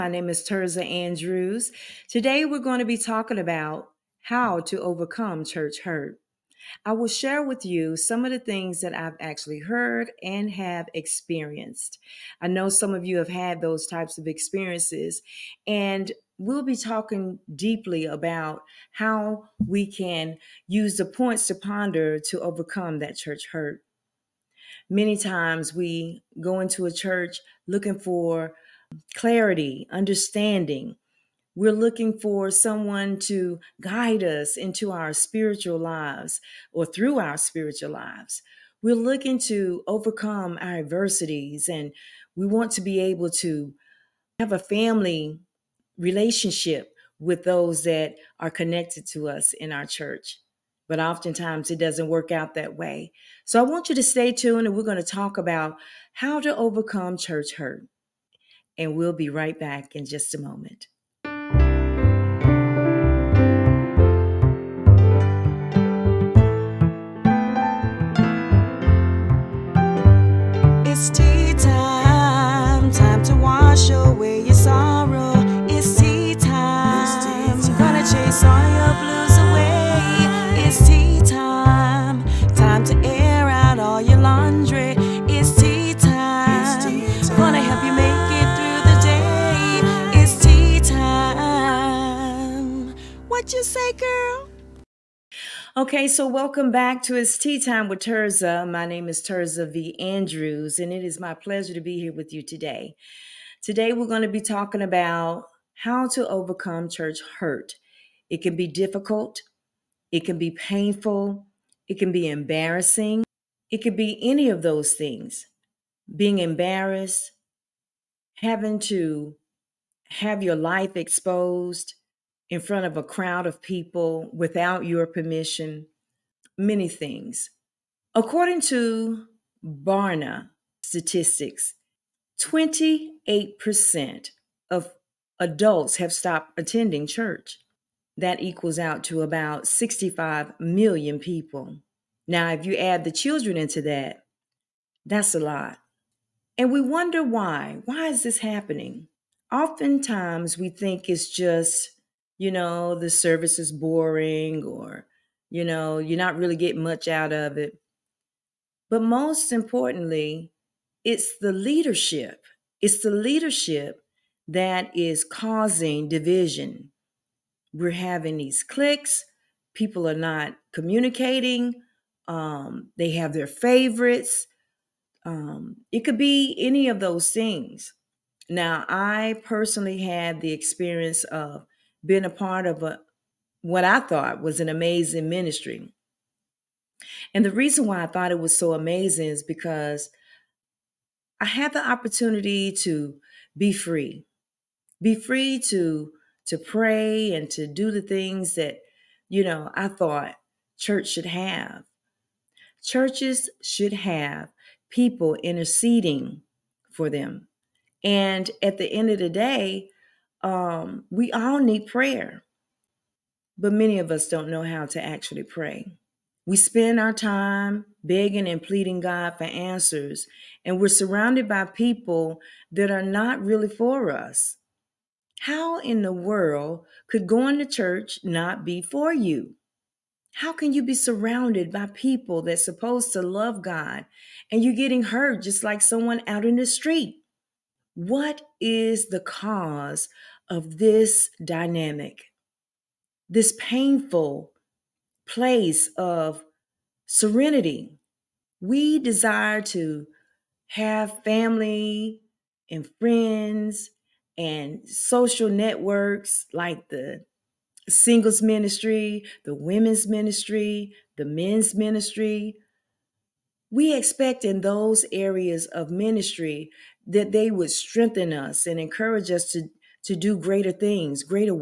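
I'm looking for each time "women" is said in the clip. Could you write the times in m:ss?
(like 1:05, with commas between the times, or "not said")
4:19.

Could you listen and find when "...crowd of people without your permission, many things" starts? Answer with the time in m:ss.
2:03.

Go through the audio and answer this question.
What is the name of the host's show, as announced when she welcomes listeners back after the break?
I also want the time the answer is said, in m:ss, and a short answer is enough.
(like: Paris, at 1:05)
It's Tea Time with Tirzah, at 1:37.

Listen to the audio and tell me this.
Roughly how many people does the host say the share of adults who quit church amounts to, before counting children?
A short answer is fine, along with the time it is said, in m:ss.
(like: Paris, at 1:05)
65 million, at 2:19.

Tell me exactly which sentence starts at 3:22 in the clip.
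Churches should have people interceding for them.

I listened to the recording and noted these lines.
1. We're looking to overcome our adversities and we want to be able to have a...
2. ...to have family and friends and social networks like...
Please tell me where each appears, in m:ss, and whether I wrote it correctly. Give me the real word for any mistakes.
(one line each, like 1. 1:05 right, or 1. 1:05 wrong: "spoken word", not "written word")
1. 0:38 right
2. 4:09 right.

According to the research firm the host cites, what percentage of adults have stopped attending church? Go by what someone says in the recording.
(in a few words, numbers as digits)
28%.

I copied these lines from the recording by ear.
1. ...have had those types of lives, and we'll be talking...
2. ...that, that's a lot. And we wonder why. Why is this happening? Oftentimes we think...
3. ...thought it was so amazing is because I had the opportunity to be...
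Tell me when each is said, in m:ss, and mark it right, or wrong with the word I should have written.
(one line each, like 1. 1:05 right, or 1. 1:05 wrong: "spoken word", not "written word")
1. 0:13 wrong: "experiences", not "lives"
2. 2:23 right
3. 3:08 right.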